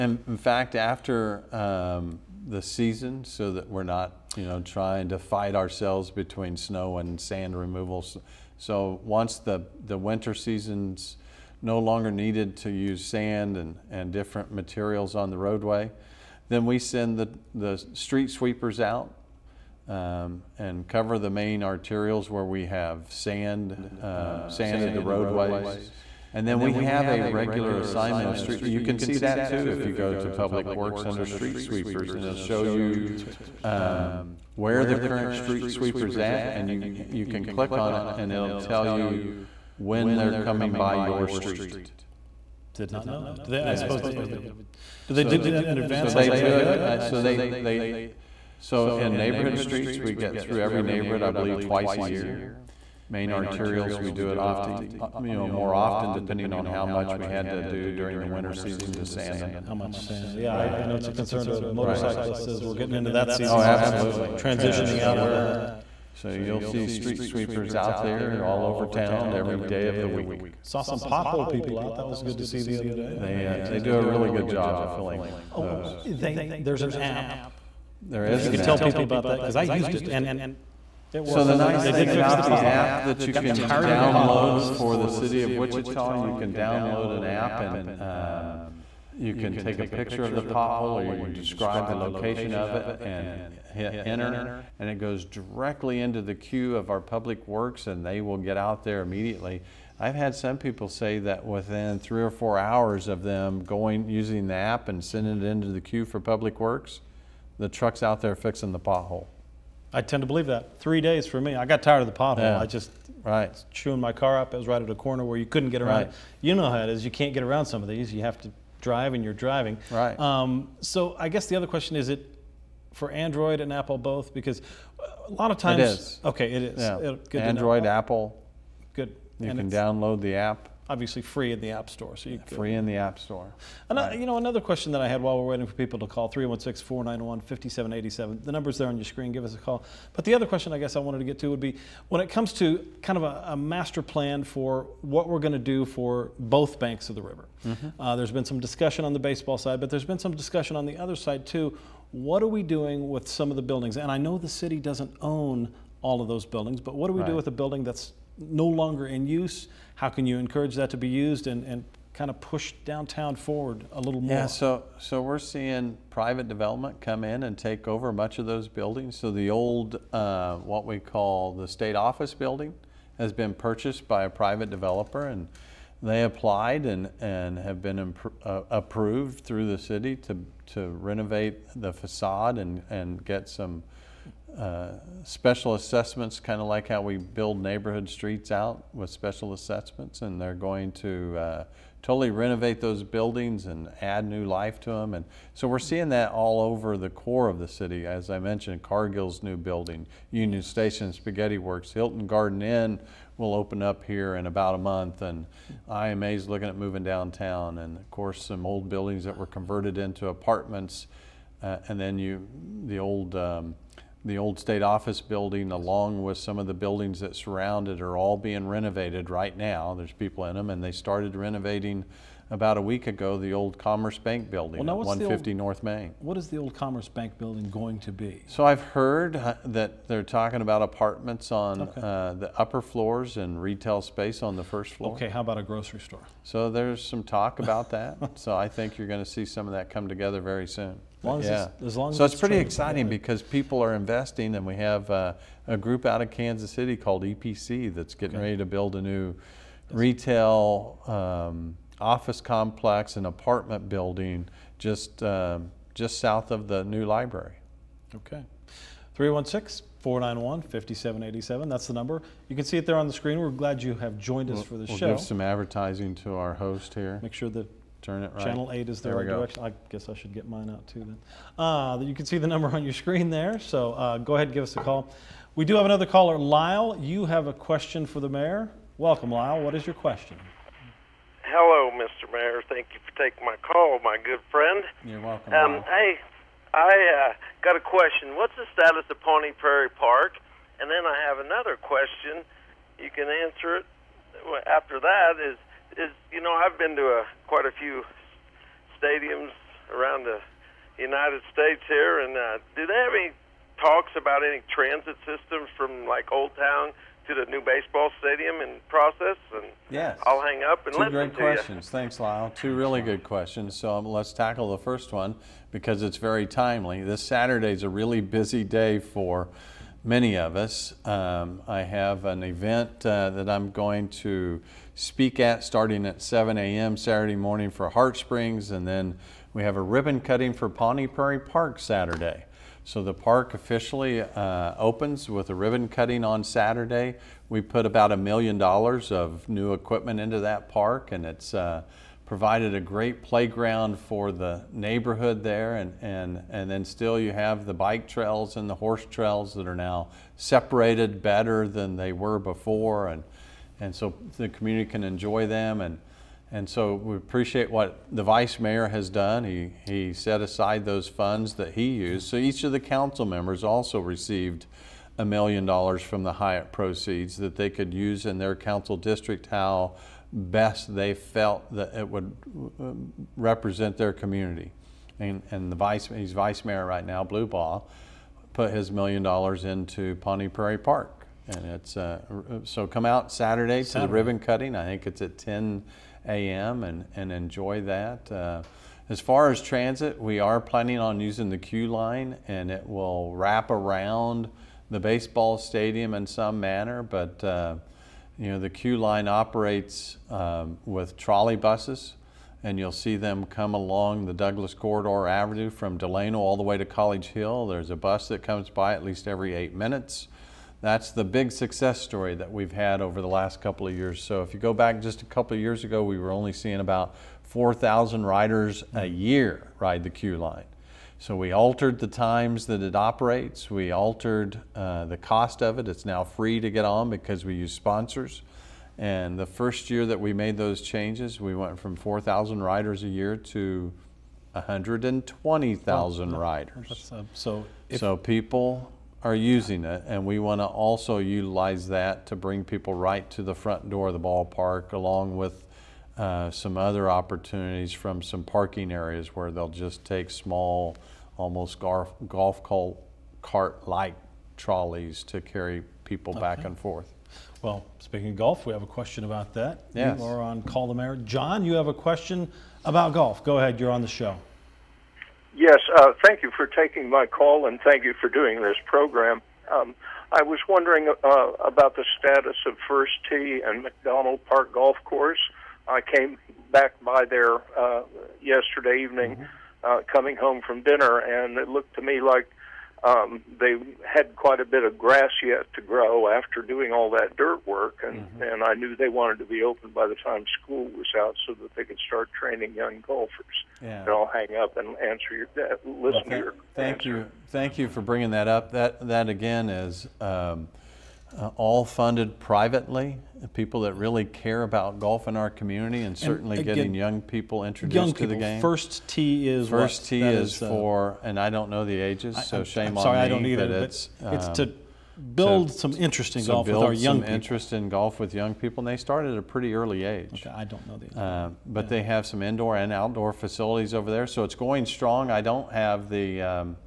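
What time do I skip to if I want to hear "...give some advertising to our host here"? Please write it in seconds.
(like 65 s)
265 s.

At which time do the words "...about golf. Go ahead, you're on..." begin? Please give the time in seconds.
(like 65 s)
462 s.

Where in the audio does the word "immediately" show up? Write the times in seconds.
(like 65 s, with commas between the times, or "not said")
99 s.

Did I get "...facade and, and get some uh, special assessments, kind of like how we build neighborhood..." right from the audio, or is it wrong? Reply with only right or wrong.
right.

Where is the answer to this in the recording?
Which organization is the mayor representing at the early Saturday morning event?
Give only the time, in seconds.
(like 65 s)
327 s.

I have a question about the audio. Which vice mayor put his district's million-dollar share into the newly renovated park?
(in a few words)
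Blubaugh.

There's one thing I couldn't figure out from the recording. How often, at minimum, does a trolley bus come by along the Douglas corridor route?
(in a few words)
every 8 minutes.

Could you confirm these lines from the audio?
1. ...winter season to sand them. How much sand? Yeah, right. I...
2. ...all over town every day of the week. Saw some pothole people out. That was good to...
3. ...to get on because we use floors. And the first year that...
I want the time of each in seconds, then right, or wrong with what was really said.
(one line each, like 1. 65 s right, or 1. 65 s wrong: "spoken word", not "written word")
1. 58 s right
2. 68 s right
3. 426 s wrong: "sponsors", not "floors".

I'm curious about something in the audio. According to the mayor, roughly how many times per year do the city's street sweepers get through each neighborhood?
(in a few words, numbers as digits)
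twice a year.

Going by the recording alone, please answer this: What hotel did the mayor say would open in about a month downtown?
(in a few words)
Hilton Garden Inn.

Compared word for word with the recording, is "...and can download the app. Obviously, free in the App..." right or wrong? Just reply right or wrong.
right.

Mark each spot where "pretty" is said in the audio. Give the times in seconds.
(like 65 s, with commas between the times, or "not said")
242 s, 519 s.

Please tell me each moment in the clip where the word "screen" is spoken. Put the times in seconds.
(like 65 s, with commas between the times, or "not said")
139 s, 263 s, 272 s.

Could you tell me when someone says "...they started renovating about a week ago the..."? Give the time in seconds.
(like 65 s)
220 s.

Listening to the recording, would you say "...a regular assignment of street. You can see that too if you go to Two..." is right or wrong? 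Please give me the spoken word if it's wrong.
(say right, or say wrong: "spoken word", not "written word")
wrong: "Public", not "Two".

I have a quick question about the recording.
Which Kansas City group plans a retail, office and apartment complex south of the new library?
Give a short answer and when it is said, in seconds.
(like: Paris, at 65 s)
EPC, at 247 s.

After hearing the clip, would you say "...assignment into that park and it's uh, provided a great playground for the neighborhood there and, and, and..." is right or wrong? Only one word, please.
wrong.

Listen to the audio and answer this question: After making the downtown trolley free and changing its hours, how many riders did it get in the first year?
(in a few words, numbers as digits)
120,000.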